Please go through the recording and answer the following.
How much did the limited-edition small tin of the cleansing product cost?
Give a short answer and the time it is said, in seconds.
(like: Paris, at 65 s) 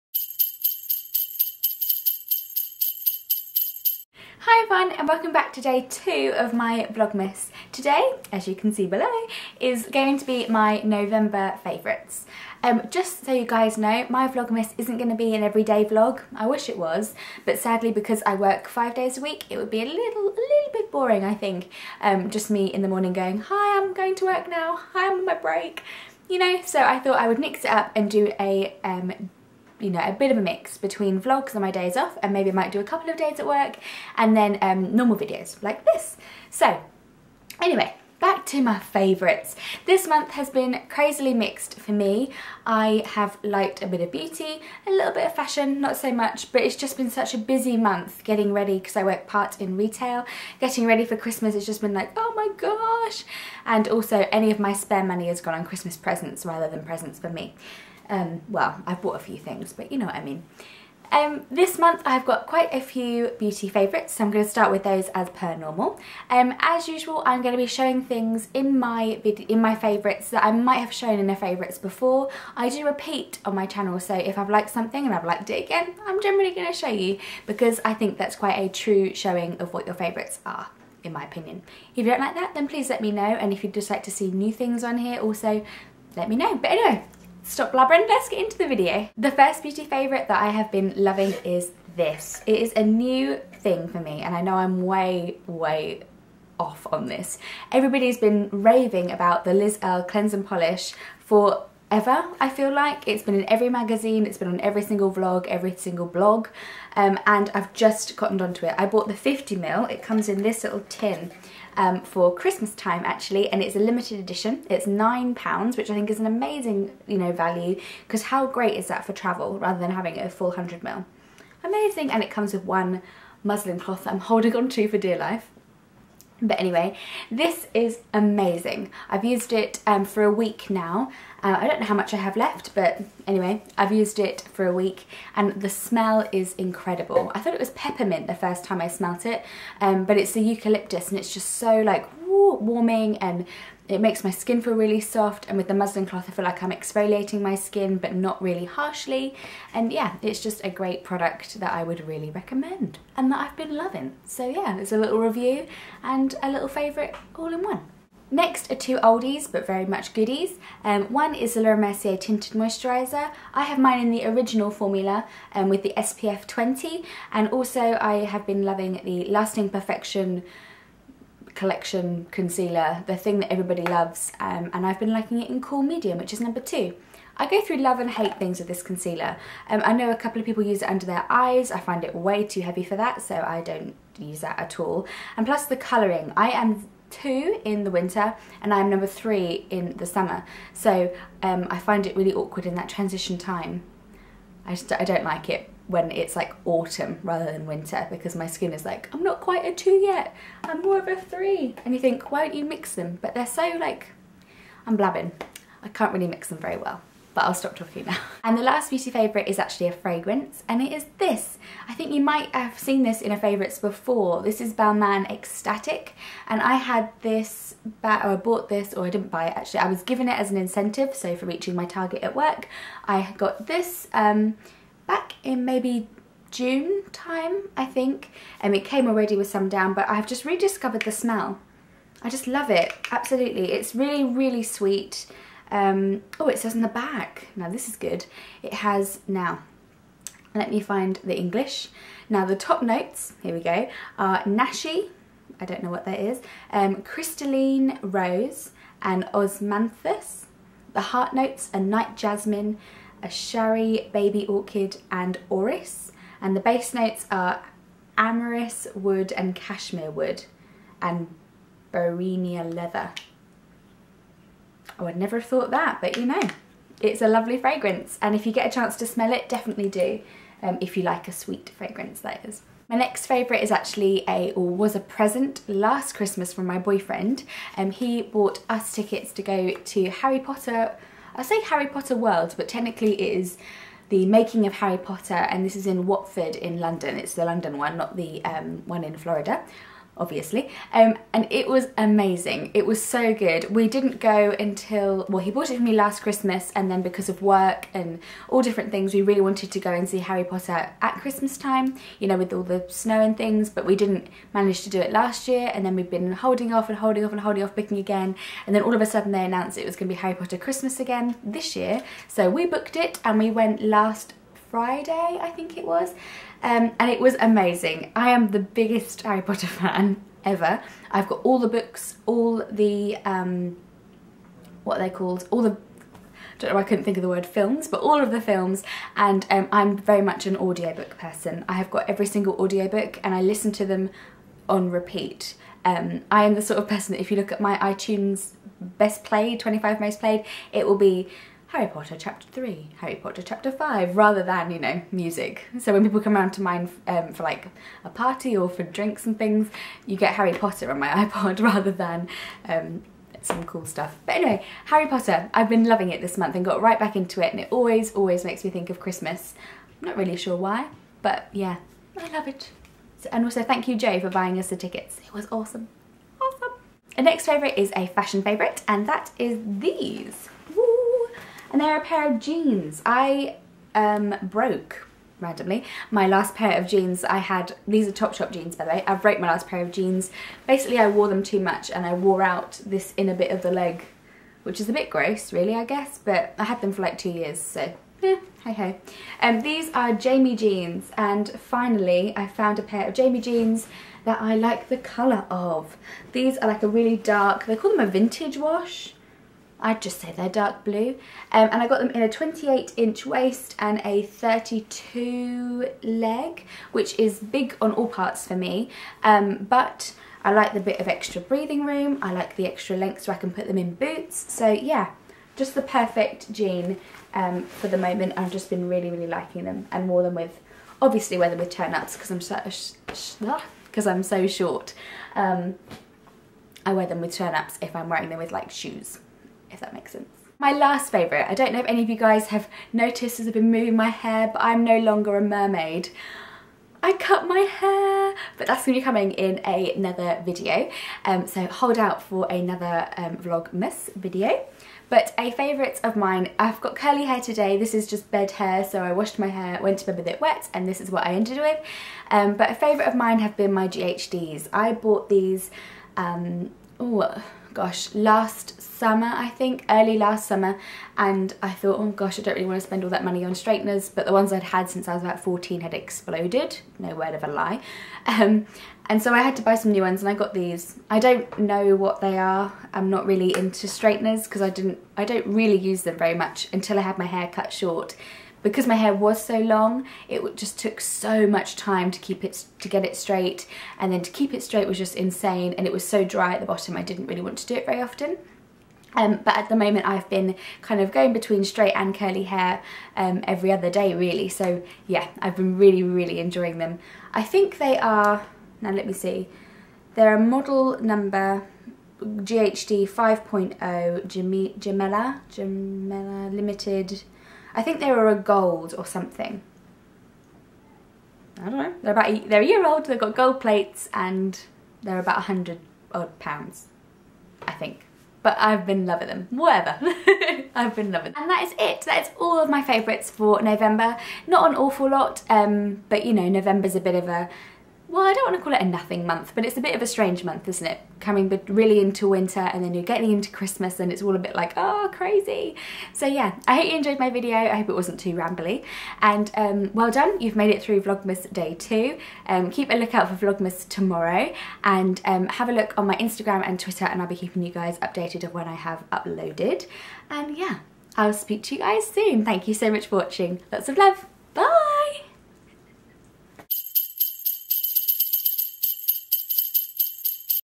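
£9, at 114 s.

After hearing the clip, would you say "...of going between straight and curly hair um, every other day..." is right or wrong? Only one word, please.
right.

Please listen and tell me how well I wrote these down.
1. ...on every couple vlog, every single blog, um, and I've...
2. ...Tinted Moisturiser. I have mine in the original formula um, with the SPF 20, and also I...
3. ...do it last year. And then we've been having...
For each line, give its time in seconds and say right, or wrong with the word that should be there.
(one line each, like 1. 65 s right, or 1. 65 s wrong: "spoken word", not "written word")
1. 104 s wrong: "single", not "couple"
2. 162 s right
3. 304 s wrong: "holding", not "having".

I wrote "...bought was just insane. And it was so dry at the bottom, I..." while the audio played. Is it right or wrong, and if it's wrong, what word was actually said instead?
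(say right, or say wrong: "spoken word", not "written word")
wrong: "straight", not "bought".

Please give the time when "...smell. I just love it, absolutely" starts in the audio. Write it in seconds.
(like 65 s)
231 s.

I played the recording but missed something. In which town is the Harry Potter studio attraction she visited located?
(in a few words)
Watford.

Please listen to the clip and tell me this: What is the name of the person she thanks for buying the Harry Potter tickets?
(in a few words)
Joe.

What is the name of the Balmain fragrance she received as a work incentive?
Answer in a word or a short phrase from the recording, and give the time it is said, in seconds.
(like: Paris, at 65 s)
Extatic, at 215 s.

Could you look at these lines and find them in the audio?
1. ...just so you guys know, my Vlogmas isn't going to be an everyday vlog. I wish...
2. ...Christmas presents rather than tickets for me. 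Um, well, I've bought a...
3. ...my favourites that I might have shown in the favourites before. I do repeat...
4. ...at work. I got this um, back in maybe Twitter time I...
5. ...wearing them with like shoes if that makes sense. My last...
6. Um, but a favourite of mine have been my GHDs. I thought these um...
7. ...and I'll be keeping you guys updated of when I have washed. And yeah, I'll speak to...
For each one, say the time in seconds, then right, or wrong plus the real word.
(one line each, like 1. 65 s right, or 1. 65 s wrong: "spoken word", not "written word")
1. 12 s right
2. 55 s wrong: "presents", not "tickets"
3. 69 s right
4. 222 s wrong: "June", not "Twitter"
5. 428 s right
6. 452 s wrong: "bought", not "thought"
7. 547 s wrong: "uploaded", not "washed".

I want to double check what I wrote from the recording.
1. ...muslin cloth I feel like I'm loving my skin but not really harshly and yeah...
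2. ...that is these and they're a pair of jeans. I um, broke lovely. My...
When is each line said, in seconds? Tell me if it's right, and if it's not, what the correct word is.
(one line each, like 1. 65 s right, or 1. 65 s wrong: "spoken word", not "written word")
1. 145 s wrong: "exfoliating", not "loving"
2. 369 s wrong: "randomly", not "lovely".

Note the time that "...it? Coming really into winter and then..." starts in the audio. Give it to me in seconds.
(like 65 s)
530 s.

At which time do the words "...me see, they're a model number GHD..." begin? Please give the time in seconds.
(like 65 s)
499 s.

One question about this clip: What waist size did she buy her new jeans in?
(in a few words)
28 inch.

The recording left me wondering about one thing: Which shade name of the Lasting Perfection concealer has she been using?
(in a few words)
Cool Medium.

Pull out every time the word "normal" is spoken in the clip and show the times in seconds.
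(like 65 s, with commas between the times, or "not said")
34 s, 65 s.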